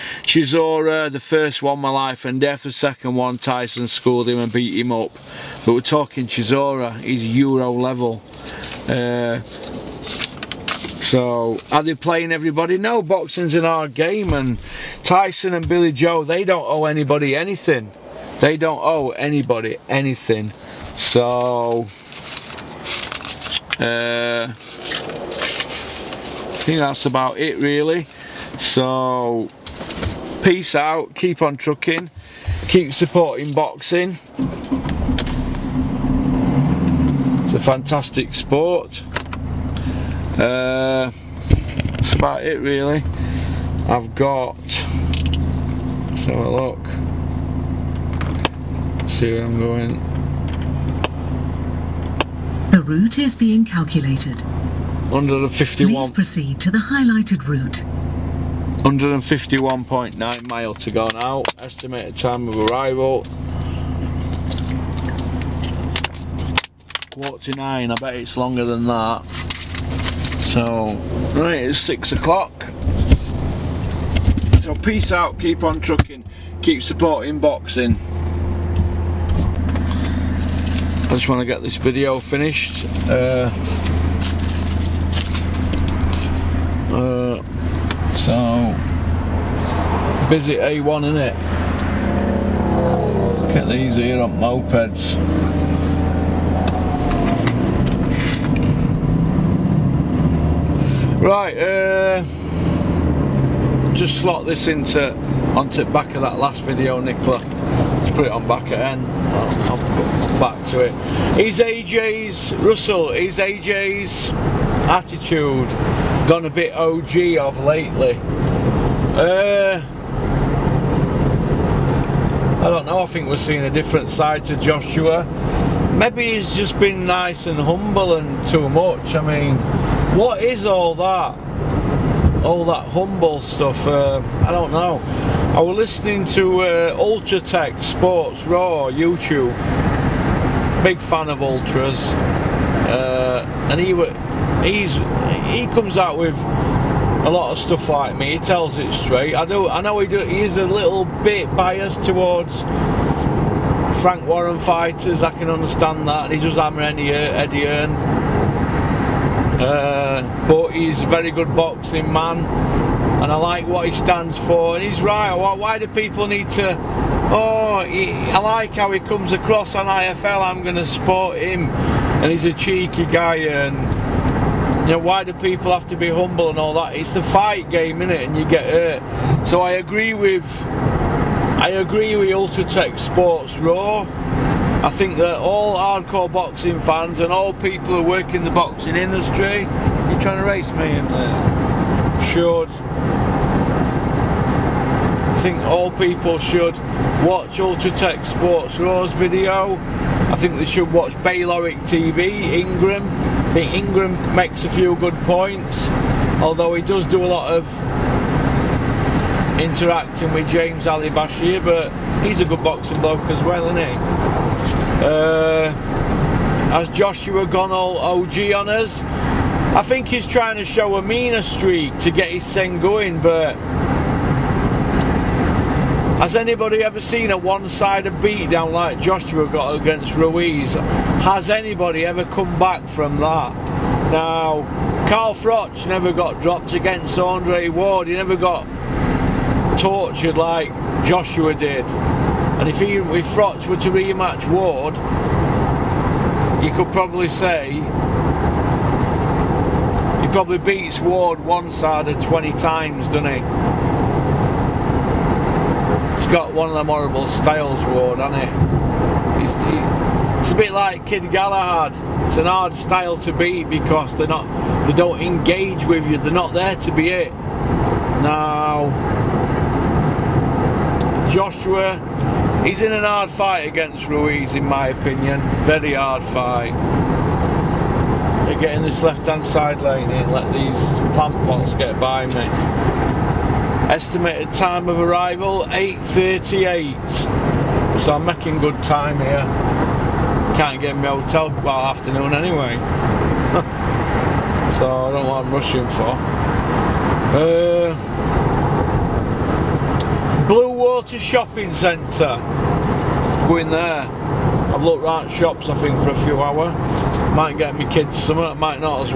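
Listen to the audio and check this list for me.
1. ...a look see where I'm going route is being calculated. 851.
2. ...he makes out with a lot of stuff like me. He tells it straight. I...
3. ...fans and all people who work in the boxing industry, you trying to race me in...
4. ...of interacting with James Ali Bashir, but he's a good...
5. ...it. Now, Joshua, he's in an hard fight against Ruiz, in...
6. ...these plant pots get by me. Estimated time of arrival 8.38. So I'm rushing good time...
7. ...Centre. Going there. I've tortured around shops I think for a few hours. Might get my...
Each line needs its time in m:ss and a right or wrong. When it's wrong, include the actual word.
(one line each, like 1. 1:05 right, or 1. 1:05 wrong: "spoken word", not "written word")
1. 0:46 wrong: "151", not "851"
2. 2:25 wrong: "comes", not "makes"
3. 3:06 right
4. 3:27 right
5. 4:27 right
6. 4:40 wrong: "making", not "rushing"
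7. 5:01 wrong: "looked", not "tortured".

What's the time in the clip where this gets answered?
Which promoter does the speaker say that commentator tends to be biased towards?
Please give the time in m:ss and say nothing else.
2:34.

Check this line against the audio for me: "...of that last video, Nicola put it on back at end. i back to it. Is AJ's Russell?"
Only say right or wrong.
right.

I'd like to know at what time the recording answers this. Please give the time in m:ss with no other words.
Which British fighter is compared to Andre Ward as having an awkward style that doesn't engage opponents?
4:21.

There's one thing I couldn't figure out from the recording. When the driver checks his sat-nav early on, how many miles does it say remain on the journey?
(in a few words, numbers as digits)
151.9.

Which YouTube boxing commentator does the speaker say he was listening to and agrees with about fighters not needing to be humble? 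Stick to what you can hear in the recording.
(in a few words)
Tech Sports Raw.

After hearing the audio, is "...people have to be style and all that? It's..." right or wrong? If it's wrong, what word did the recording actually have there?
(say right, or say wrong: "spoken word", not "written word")
wrong: "humble", not "style".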